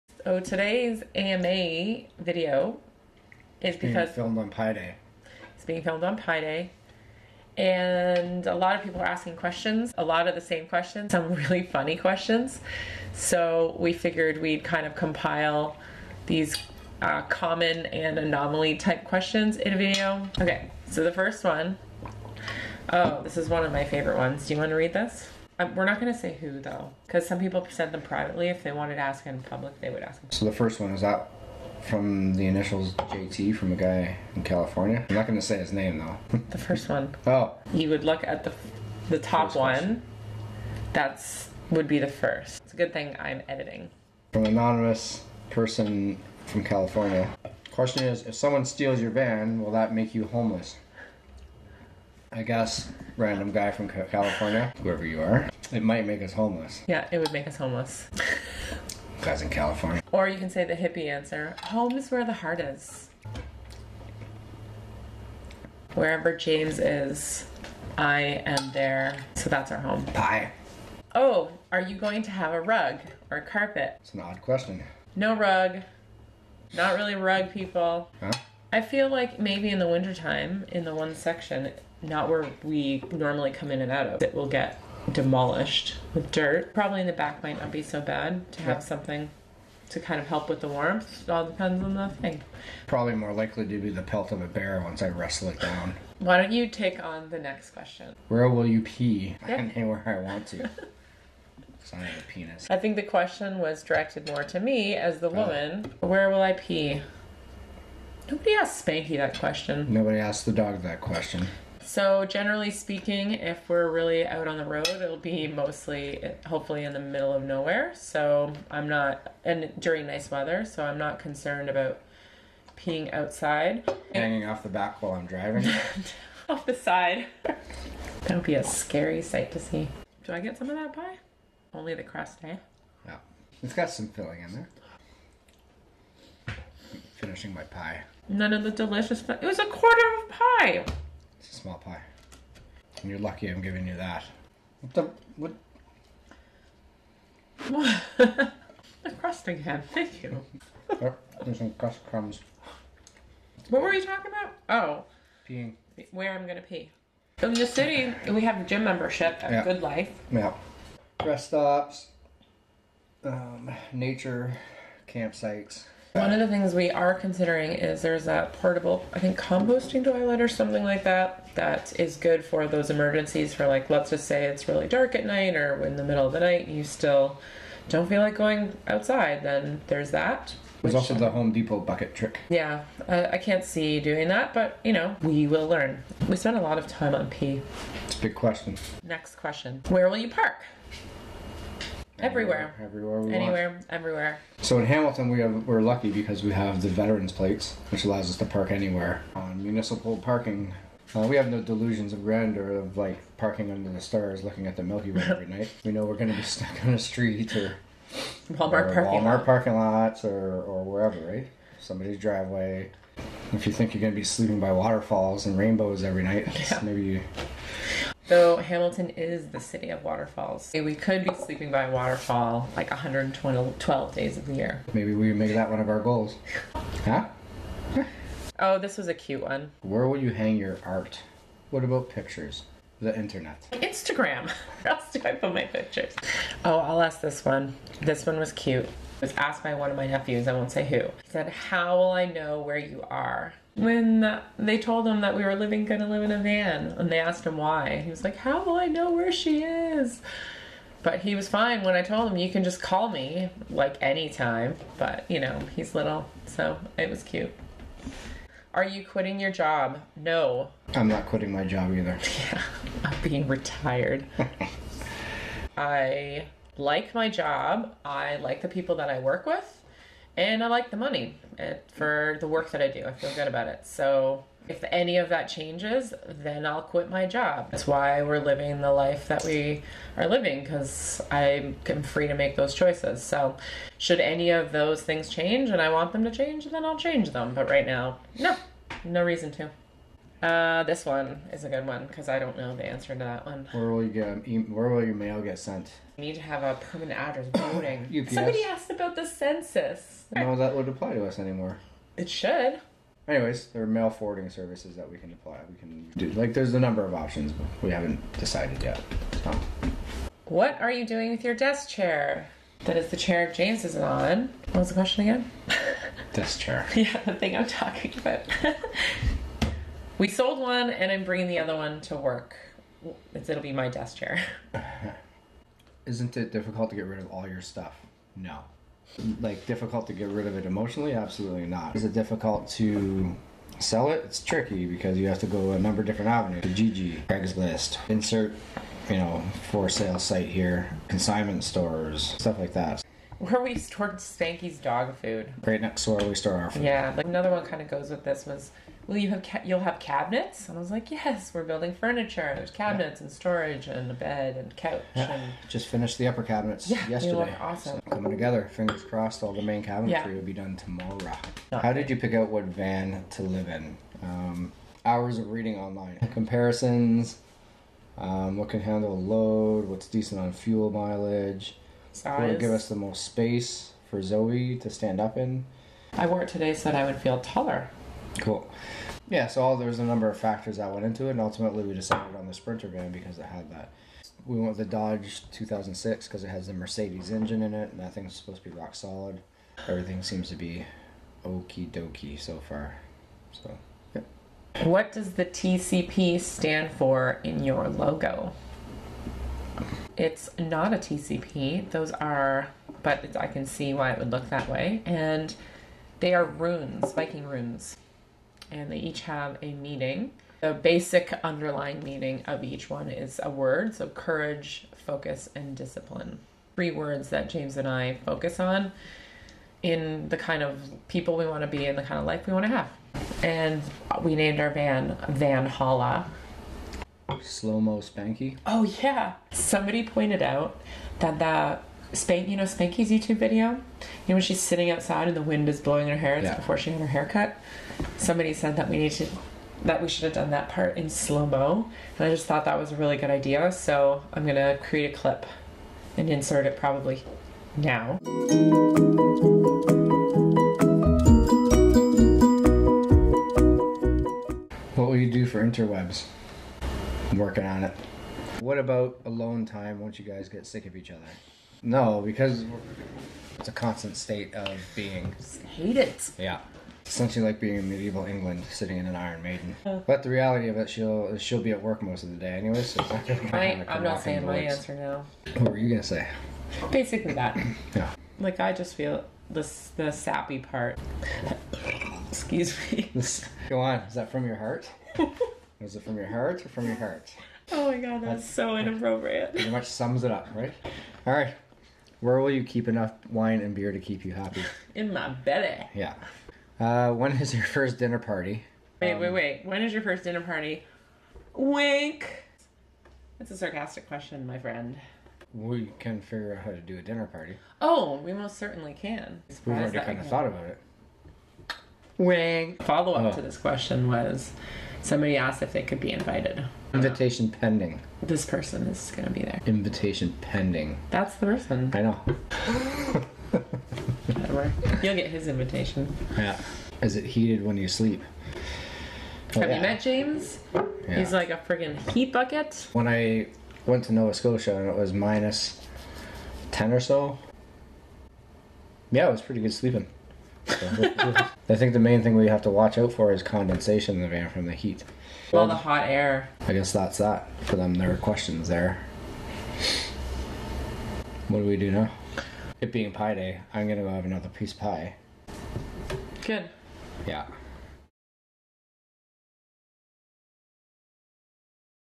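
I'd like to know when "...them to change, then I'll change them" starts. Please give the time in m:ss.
4:46.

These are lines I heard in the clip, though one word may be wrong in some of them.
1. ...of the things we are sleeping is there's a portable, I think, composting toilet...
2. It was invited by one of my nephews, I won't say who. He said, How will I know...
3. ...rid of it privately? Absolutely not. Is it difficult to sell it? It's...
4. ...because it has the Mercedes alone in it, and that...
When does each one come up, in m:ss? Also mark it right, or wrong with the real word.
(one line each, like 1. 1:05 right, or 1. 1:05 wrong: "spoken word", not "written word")
1. 2:46 wrong: "considering", not "sleeping"
2. 3:58 wrong: "asked", not "invited"
3. 5:30 wrong: "emotionally", not "privately"
4. 6:26 wrong: "engine", not "alone".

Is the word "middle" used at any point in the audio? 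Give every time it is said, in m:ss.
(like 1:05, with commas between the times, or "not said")
1:57, 2:56.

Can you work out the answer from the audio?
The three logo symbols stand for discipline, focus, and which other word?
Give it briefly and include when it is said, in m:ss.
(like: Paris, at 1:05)
courage, at 6:54.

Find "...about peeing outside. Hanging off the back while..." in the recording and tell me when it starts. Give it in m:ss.
2:01.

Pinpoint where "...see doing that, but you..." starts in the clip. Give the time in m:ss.
3:03.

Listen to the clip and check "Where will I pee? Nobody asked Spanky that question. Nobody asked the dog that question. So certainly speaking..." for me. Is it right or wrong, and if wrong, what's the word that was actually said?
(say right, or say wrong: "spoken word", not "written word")
wrong: "generally", not "certainly".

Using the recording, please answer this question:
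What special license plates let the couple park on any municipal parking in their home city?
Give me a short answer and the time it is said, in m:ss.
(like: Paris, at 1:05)
veterans plates, at 3:16.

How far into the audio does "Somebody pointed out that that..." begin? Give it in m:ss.
7:09.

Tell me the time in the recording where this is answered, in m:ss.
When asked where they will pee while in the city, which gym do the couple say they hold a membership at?
2:39.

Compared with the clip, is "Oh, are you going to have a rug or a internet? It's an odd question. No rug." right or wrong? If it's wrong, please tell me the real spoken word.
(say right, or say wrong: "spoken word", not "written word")
wrong: "carpet", not "internet".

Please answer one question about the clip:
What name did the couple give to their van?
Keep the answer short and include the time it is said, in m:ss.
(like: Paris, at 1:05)
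Van Holla, at 7:05.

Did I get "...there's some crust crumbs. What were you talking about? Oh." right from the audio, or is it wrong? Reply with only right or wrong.
right.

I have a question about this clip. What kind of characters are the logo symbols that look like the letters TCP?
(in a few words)
Viking runes.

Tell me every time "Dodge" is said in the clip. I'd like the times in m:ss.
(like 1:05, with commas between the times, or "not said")
6:24.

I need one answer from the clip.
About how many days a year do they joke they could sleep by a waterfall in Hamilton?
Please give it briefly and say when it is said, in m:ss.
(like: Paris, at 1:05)
112, at 3:42.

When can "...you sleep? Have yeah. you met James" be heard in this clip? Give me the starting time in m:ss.
8:47.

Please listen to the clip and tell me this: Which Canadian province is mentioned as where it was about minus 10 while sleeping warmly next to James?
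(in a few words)
Nova Scotia.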